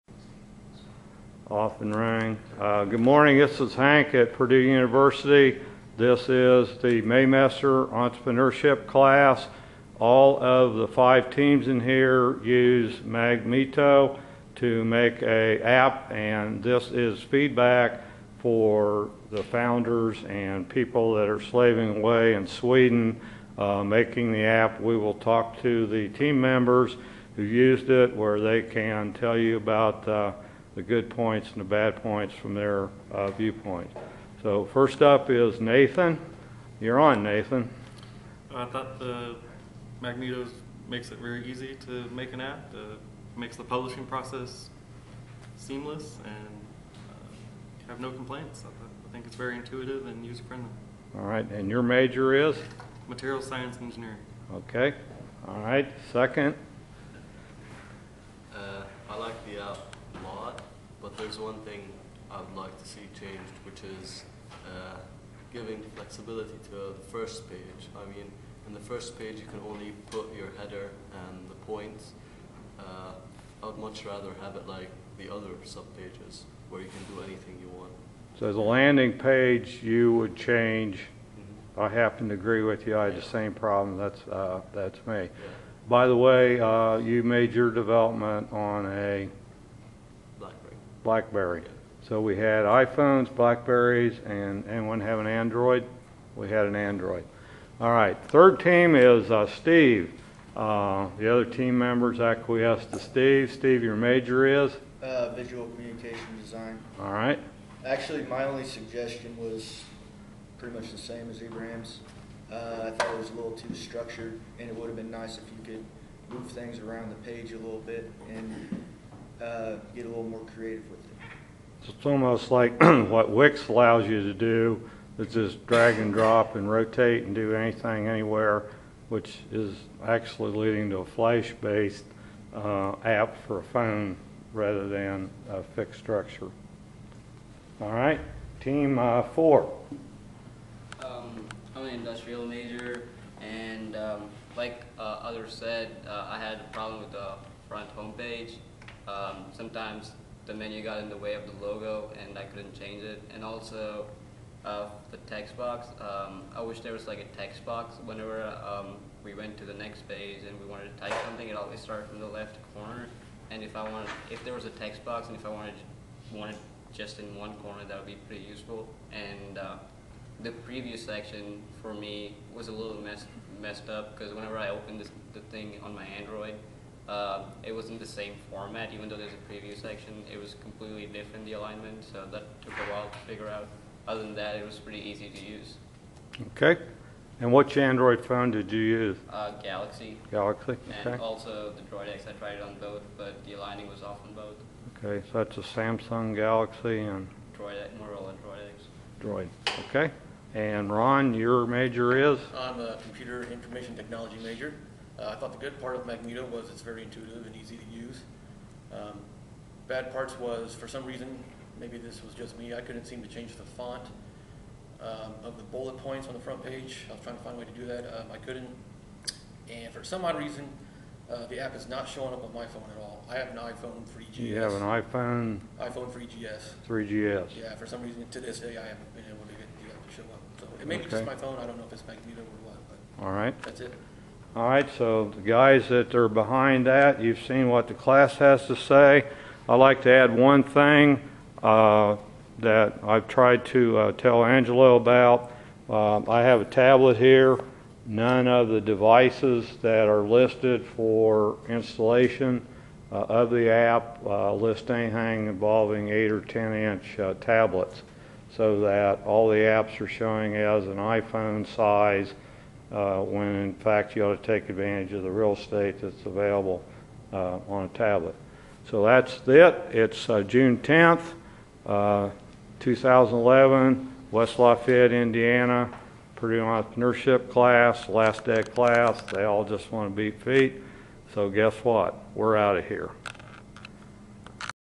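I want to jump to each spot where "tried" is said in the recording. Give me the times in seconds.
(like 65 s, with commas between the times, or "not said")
192 s, 243 s.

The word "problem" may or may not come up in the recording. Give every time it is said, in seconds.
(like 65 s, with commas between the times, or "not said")
83 s, 146 s.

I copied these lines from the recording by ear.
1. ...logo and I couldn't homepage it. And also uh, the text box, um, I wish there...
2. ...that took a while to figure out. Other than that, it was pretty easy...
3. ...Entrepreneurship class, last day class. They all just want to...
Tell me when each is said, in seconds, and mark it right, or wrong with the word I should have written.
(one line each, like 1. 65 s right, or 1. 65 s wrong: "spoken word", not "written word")
1. 151 s wrong: "change", not "homepage"
2. 182 s right
3. 276 s right.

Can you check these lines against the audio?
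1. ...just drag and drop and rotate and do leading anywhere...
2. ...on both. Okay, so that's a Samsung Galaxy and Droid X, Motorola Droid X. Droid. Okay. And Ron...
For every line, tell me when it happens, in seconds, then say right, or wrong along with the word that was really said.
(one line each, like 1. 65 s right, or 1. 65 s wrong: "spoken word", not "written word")
1. 125 s wrong: "anything", not "leading"
2. 194 s right.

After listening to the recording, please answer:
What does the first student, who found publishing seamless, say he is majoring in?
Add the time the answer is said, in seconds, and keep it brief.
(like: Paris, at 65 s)
Material science engineering, at 53 s.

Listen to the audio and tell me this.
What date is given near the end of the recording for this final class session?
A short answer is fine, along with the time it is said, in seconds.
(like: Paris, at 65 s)
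June 10th, 2011, at 270 s.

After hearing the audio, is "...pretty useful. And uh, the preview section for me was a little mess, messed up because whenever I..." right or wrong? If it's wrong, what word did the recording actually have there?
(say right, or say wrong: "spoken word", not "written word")
right.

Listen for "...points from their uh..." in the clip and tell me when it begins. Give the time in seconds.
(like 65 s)
32 s.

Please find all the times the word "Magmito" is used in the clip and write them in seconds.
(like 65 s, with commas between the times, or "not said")
12 s, 40 s, 206 s, 232 s.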